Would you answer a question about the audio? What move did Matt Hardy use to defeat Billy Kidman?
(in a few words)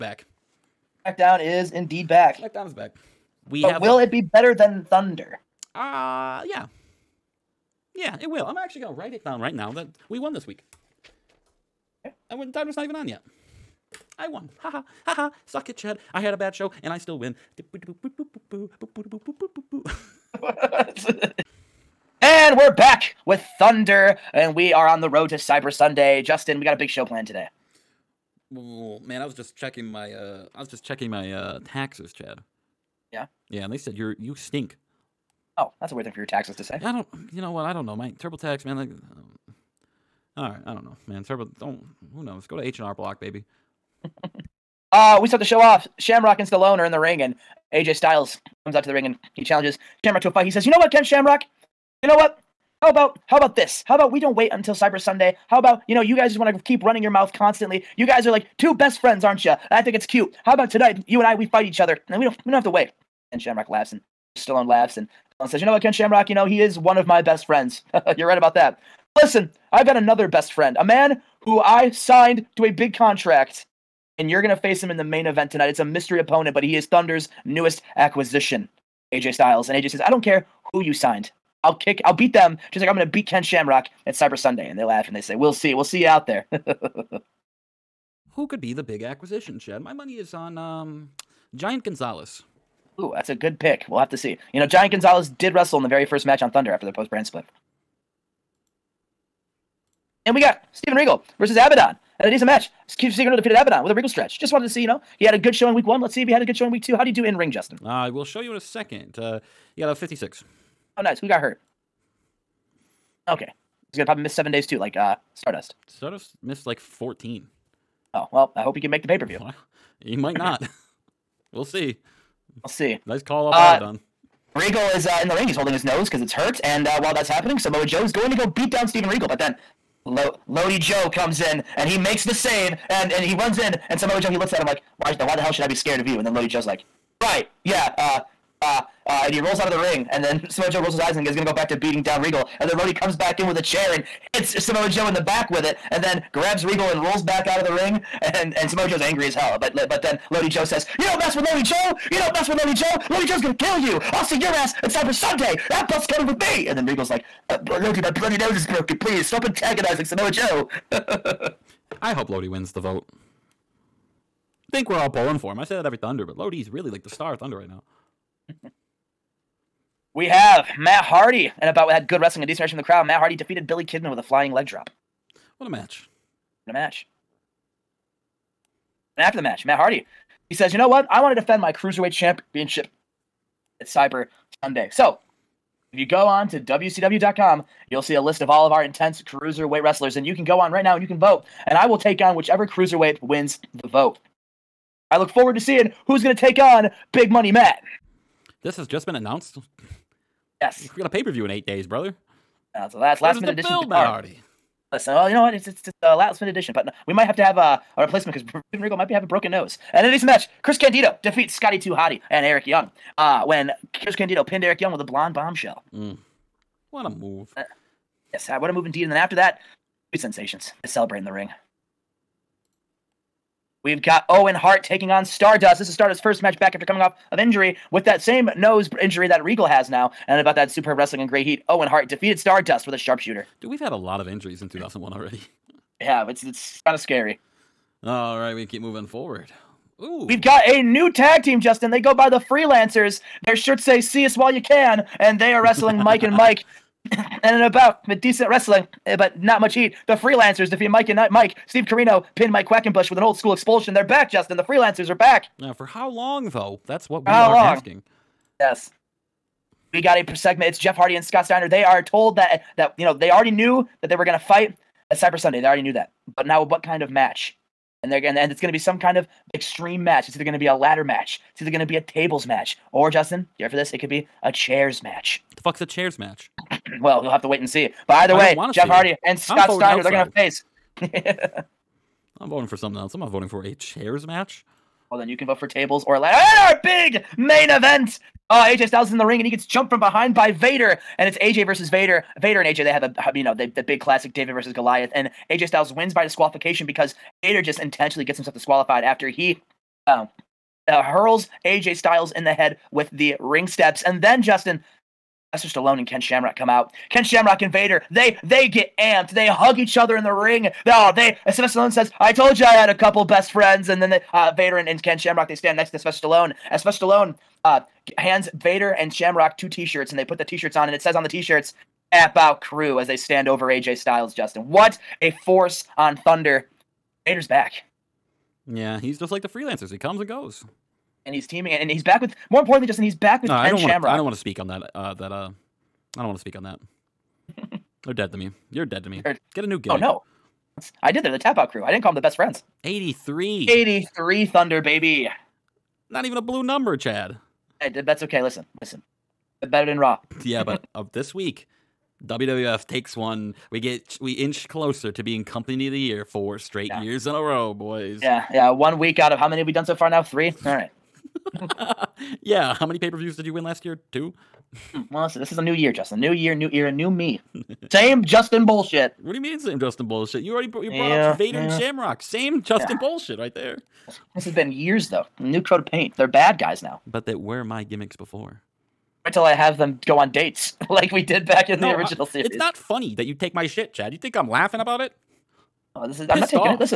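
Flying leg drop.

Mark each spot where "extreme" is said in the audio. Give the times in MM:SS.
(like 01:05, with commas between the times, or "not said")
04:29.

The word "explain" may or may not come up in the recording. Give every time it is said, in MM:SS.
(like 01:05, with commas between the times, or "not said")
not said.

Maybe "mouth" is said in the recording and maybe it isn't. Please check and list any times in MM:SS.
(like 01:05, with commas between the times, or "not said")
00:57.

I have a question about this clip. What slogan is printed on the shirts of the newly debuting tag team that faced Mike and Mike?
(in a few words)
See us while you can.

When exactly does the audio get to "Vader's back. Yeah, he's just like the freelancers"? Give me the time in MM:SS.
05:27.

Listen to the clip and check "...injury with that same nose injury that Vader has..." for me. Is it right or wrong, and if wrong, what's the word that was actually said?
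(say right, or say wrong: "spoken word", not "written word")
wrong: "Regal", not "Vader".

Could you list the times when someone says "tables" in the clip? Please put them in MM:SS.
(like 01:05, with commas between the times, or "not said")
04:32, 04:45.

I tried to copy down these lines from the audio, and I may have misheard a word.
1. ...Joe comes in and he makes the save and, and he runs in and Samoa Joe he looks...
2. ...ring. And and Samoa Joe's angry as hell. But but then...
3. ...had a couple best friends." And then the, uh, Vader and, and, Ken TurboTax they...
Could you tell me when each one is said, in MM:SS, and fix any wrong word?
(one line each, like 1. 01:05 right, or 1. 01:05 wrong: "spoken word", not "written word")
1. 02:10 right
2. 02:27 right
3. 05:12 wrong: "Shamrock", not "TurboTax".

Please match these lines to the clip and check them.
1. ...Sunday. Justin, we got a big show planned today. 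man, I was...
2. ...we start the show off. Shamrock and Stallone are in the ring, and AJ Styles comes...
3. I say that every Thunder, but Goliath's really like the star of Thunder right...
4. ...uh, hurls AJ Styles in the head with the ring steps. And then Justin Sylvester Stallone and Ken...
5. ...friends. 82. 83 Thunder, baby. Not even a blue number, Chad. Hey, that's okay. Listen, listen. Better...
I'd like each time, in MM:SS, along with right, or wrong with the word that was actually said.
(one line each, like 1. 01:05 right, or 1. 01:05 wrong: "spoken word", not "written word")
1. 00:25 right
2. 00:45 right
3. 02:45 wrong: "Lodi", not "Goliath"
4. 05:00 right
5. 05:42 wrong: "83", not "82".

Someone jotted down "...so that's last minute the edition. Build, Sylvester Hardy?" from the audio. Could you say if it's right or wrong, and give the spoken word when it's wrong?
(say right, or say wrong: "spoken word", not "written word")
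wrong: "Matt", not "Sylvester".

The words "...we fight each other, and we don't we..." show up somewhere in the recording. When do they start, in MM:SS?
01:01.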